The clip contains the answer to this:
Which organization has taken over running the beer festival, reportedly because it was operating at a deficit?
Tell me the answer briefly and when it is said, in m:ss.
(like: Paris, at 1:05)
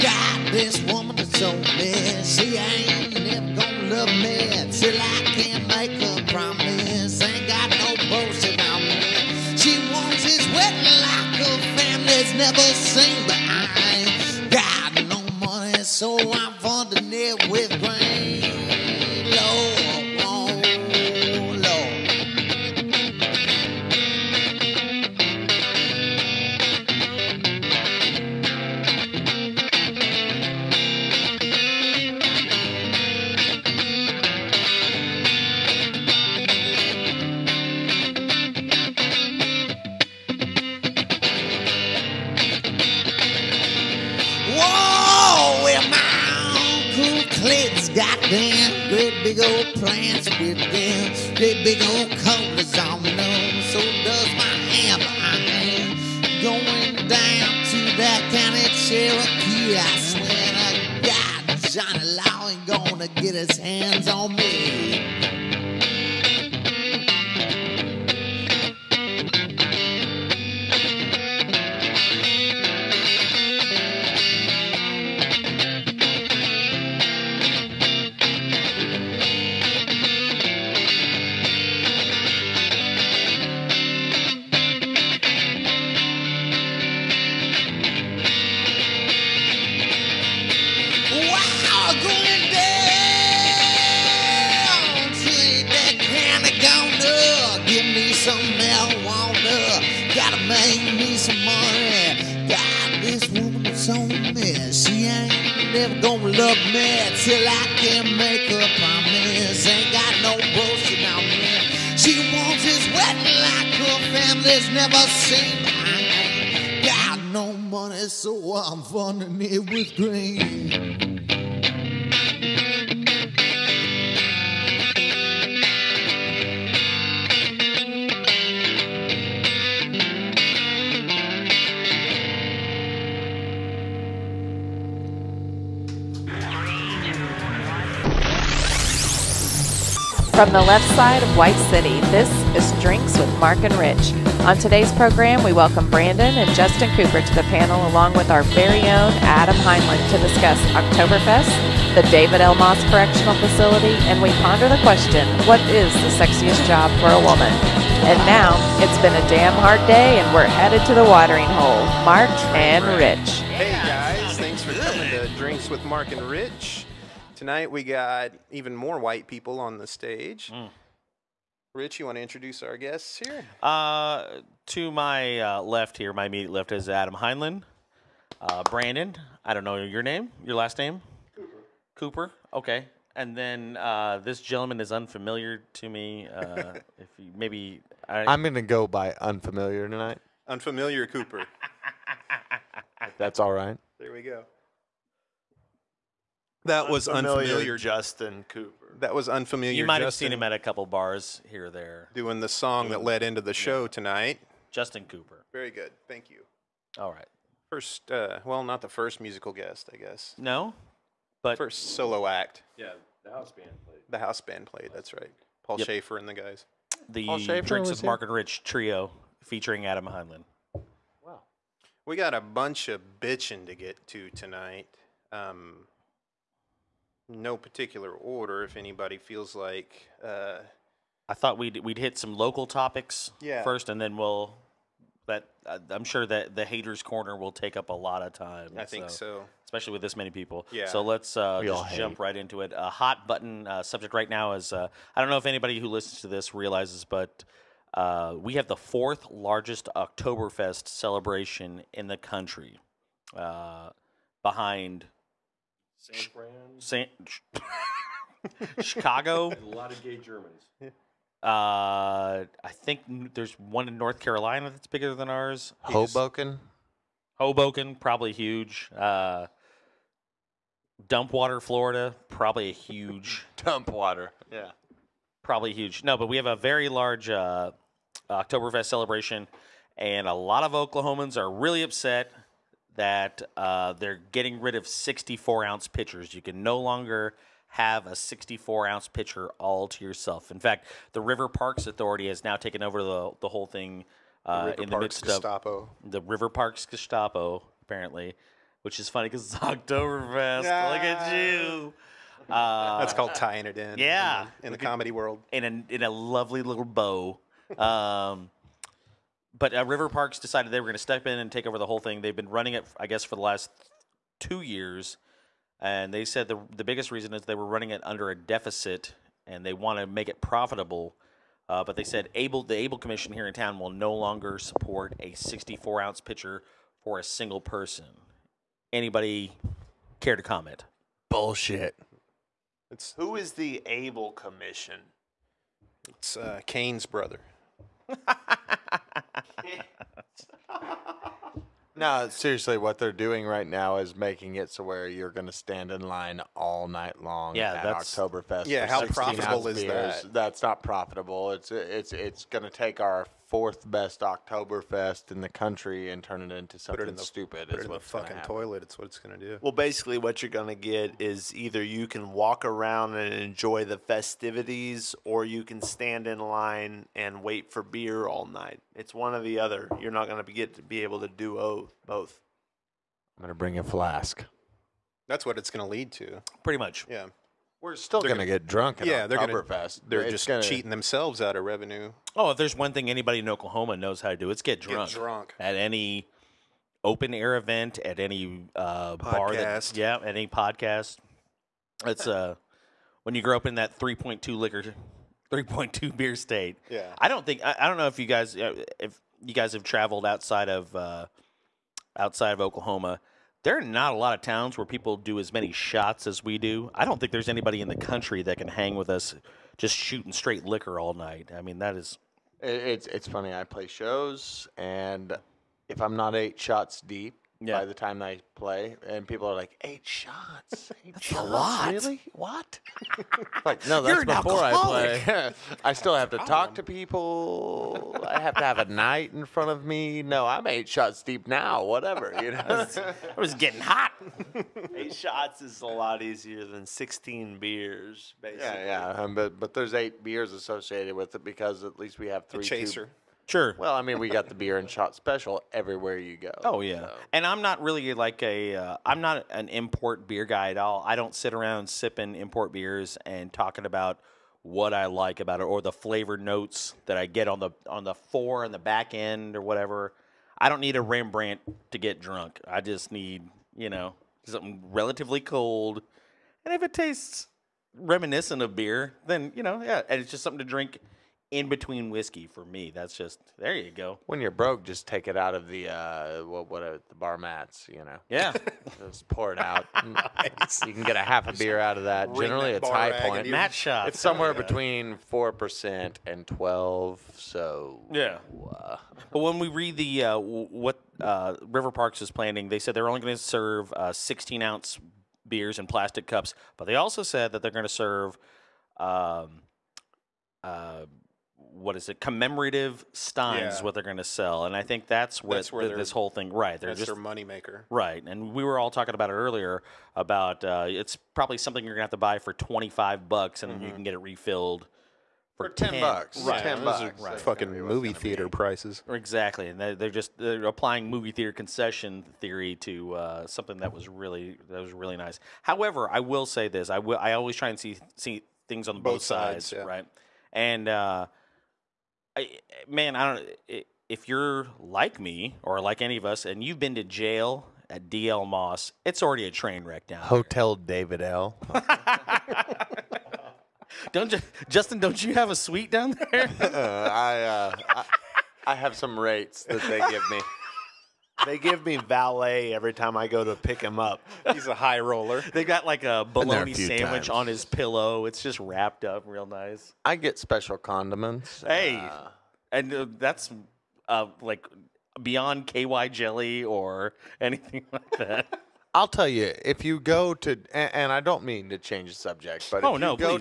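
River Parks Authority, at 4:51.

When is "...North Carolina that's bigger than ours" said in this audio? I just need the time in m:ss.
4:23.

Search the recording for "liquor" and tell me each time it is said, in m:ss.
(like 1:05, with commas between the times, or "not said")
6:34, 6:50.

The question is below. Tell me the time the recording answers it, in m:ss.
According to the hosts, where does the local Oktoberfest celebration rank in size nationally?
4:08.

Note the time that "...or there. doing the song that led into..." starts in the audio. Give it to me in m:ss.
3:21.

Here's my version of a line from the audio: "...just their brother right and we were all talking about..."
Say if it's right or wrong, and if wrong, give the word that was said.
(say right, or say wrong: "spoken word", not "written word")
wrong: "moneymaker", not "brother".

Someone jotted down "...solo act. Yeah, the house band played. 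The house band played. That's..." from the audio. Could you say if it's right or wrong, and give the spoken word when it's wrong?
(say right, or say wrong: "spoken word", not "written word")
right.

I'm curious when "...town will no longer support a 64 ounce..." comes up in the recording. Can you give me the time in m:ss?
5:23.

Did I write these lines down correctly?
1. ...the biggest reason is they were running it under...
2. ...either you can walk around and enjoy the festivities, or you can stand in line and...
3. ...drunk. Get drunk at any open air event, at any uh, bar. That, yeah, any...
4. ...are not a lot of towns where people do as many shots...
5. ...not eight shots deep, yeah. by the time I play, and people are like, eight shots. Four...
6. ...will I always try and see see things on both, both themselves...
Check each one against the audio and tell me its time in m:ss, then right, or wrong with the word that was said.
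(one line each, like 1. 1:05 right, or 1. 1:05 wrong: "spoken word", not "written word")
1. 5:16 right
2. 6:01 right
3. 6:24 right
4. 6:43 right
5. 6:56 wrong: "Eight", not "Four"
6. 8:46 wrong: "sides", not "themselves".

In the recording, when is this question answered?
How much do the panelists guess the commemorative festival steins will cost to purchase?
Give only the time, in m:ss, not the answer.
8:32.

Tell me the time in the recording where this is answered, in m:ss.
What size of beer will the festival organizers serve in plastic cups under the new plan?
8:14.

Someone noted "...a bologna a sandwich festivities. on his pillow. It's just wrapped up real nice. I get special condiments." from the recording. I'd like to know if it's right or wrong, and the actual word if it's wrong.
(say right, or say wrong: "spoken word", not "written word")
wrong: "times", not "festivities".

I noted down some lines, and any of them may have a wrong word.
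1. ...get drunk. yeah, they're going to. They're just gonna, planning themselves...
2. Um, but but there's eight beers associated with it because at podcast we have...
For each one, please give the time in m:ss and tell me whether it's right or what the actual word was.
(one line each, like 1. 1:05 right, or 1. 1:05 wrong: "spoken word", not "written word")
1. 6:18 wrong: "cheating", not "planning"
2. 7:19 wrong: "least", not "podcast".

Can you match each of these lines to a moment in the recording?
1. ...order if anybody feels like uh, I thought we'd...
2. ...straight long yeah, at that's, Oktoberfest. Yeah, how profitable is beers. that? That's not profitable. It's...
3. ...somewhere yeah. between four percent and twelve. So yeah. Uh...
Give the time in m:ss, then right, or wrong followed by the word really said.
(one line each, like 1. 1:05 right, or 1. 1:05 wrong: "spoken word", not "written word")
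1. 3:48 right
2. 5:46 wrong: "night", not "straight"
3. 8:04 right.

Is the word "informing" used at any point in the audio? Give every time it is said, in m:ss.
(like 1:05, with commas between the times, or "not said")
not said.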